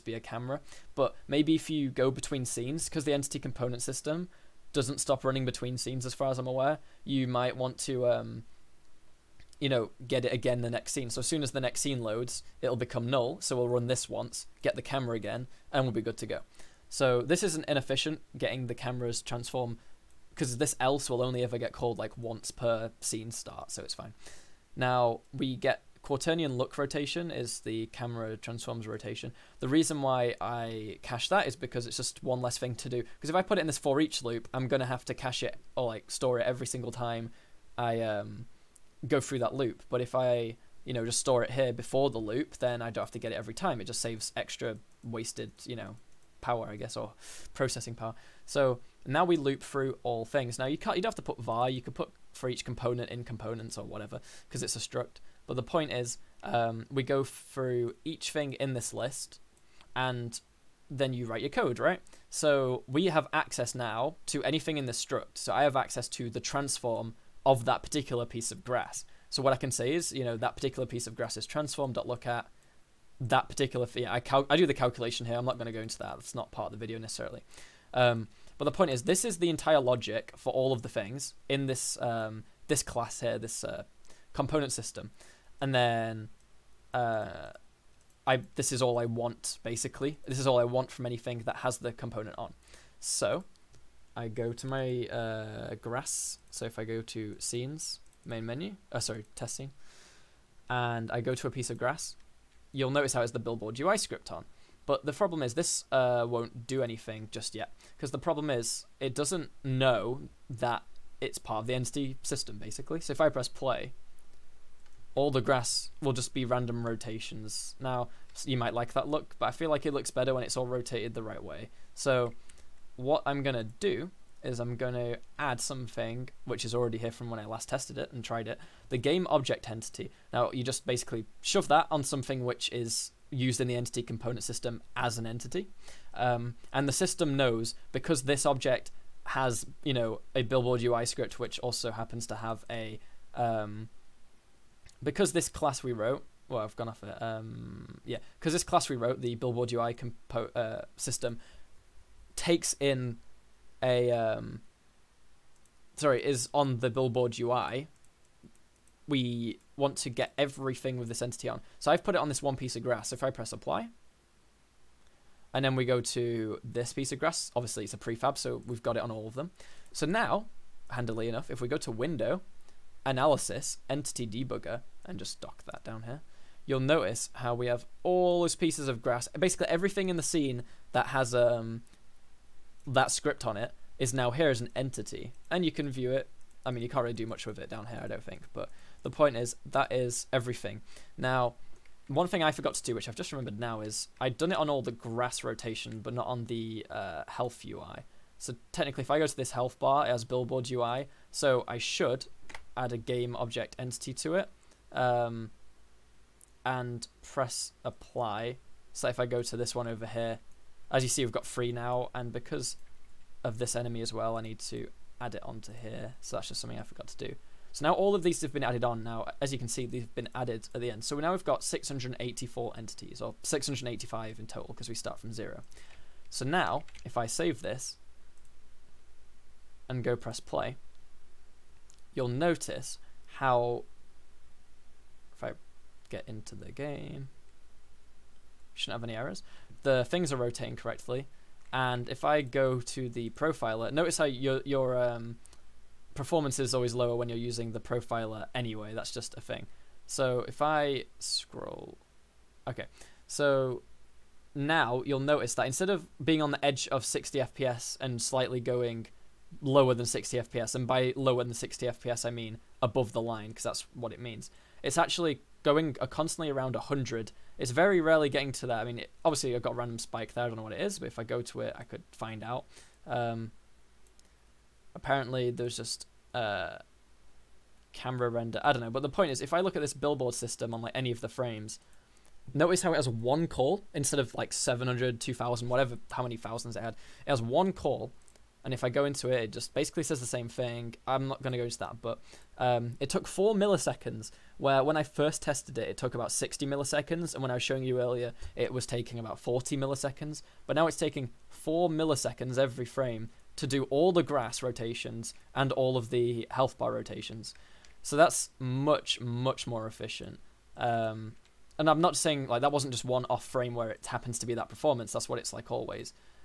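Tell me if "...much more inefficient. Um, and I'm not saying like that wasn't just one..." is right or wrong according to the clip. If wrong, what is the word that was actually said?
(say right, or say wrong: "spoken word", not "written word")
wrong: "efficient", not "inefficient".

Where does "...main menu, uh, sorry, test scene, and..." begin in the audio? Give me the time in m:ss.
1:38.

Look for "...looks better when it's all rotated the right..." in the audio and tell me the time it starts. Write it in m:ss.
1:59.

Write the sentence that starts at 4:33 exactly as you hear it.
Um, apparently there's just uh, camera render.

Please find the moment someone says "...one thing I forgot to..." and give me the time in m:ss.
3:12.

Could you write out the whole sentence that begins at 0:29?
The reason why I cache that is because it's just one less thing to do.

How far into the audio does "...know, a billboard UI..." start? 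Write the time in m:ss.
2:19.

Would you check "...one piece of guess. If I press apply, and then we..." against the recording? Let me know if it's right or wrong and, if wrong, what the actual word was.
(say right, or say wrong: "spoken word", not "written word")
wrong: "grass", not "guess".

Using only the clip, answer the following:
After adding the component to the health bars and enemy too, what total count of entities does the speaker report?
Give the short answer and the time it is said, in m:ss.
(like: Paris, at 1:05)
685, at 3:43.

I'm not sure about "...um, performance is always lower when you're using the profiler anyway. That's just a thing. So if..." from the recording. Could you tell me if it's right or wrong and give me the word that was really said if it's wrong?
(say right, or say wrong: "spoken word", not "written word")
right.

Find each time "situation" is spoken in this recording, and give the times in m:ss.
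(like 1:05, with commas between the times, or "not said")
not said.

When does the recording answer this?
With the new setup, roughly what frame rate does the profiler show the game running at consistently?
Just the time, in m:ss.
4:26.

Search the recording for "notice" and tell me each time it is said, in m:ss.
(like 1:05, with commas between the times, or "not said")
1:42, 2:56, 3:52, 4:03, 4:15, 4:42.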